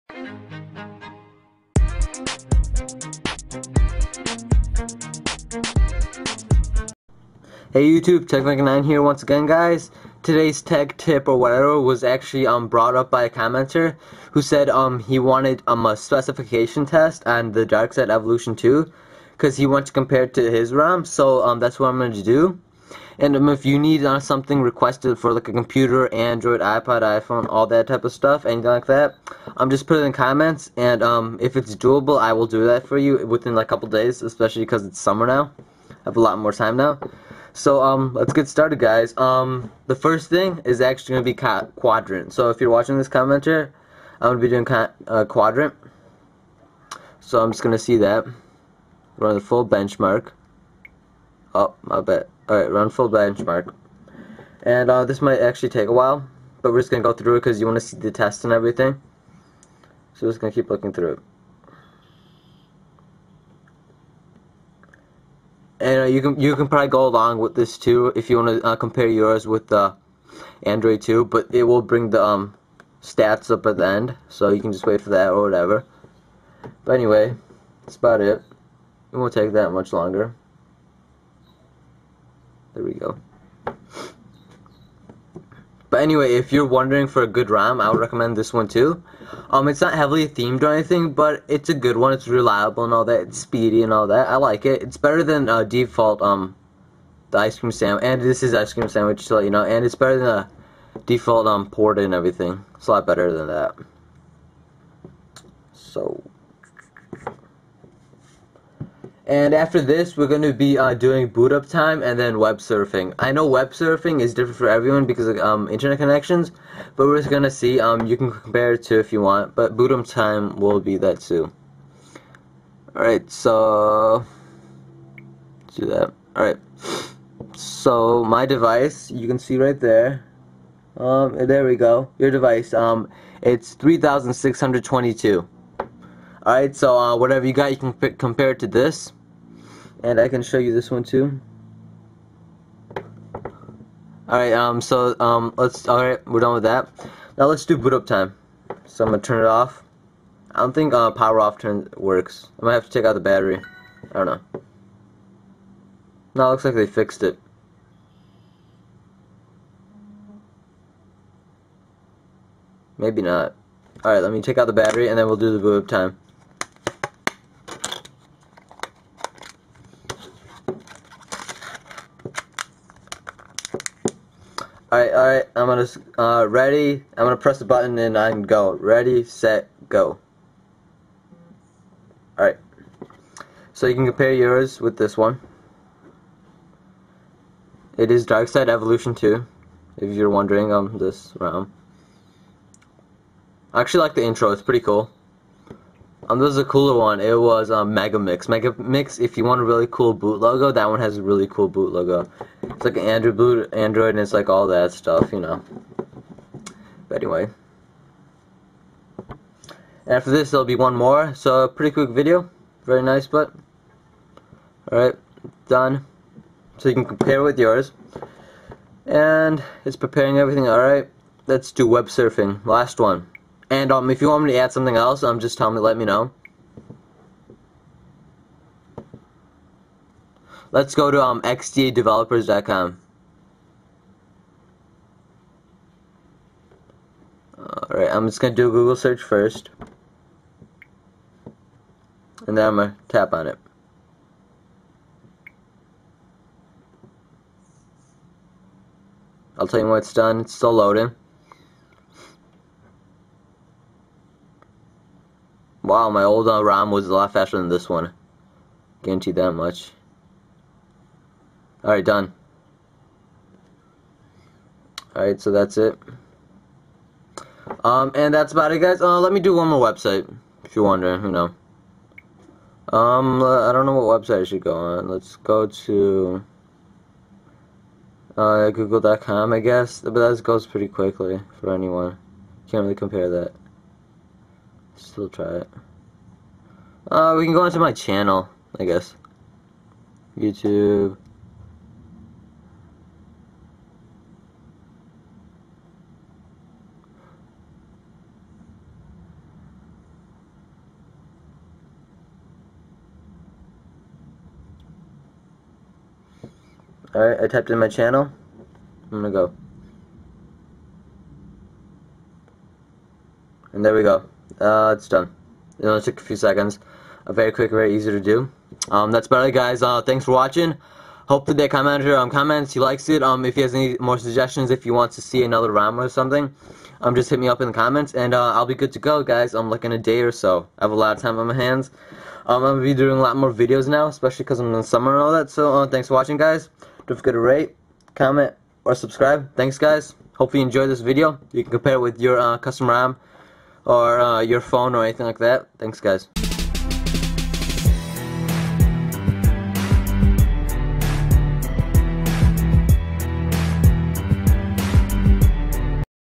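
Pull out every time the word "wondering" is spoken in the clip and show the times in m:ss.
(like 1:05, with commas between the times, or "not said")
1:26, 3:10, 4:30.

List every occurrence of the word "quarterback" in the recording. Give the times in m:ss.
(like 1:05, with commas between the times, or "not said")
not said.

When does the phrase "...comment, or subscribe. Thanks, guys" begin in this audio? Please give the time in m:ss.
5:38.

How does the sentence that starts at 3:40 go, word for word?
All right, let's do web surfing.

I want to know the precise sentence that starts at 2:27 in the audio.
Now let's do boot up time.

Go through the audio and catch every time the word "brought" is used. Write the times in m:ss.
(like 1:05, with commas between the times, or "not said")
0:12.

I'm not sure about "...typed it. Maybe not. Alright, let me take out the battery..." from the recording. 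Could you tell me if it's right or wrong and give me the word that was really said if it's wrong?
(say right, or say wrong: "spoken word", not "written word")
wrong: "fixed", not "typed".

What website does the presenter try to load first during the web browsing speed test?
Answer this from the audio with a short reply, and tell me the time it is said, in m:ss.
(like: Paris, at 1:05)
xdadevelopers.com, at 3:51.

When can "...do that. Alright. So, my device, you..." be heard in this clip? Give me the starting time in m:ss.
2:05.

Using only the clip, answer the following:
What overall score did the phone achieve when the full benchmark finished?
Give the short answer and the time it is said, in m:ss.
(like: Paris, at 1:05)
3,622, at 2:13.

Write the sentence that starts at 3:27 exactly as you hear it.
But anyway, after this there'll be one more.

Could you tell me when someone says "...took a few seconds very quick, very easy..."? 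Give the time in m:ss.
5:16.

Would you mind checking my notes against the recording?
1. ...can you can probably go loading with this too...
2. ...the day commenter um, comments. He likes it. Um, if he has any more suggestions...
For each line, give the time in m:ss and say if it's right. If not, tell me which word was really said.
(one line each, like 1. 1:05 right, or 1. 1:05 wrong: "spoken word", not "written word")
1. 1:06 wrong: "along", not "loading"
2. 5:21 right.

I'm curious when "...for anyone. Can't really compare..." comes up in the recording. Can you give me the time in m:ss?
4:41.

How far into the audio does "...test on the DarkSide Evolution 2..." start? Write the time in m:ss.
0:16.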